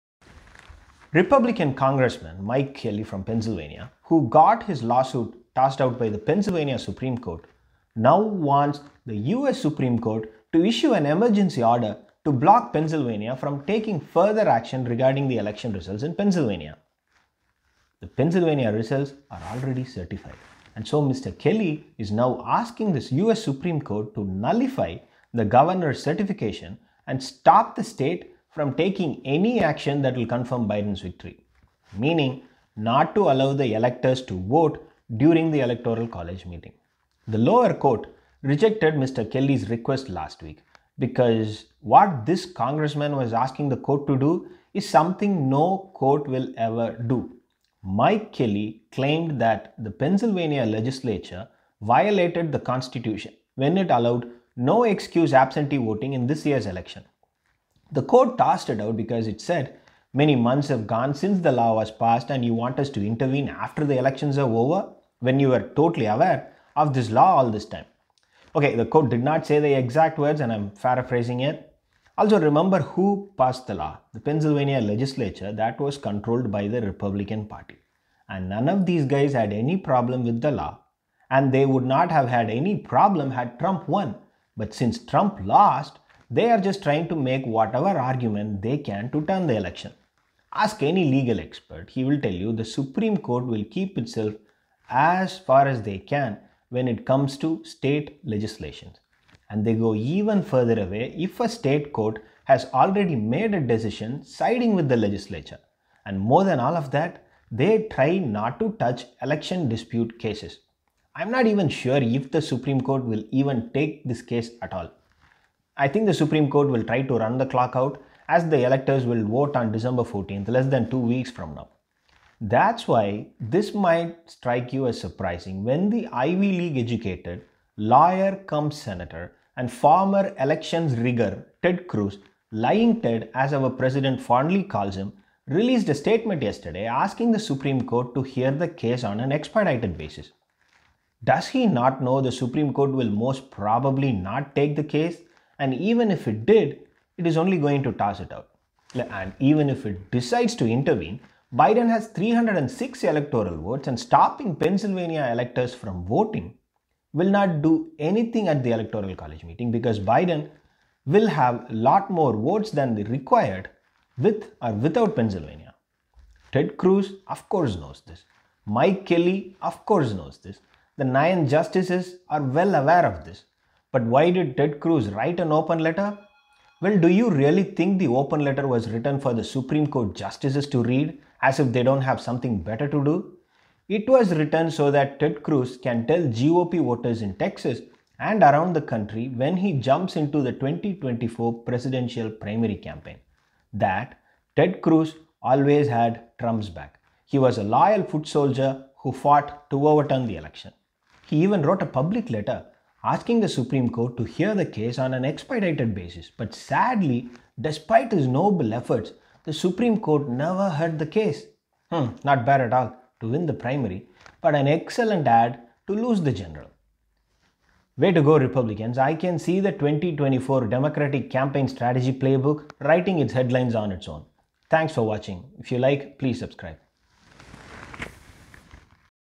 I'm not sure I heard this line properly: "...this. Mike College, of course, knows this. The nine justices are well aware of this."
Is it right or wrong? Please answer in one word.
wrong.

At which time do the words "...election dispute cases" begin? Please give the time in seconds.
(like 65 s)
109 s.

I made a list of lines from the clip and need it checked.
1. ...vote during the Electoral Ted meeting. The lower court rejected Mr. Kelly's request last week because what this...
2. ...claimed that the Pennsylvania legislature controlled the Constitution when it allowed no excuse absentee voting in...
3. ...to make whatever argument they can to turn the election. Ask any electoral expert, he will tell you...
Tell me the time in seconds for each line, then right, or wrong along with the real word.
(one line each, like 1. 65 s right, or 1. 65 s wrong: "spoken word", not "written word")
1. 34 s wrong: "College", not "Ted"
2. 48 s wrong: "violated", not "controlled"
3. 87 s wrong: "legal", not "electoral".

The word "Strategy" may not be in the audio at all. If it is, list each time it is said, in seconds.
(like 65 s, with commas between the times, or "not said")
221 s.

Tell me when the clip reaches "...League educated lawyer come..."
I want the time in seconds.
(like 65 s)
126 s.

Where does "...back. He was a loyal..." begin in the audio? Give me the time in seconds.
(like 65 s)
196 s.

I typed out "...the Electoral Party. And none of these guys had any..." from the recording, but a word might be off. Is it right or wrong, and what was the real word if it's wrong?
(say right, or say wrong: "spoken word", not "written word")
wrong: "Republican", not "Electoral".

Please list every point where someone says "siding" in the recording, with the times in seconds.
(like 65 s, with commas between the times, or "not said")
104 s.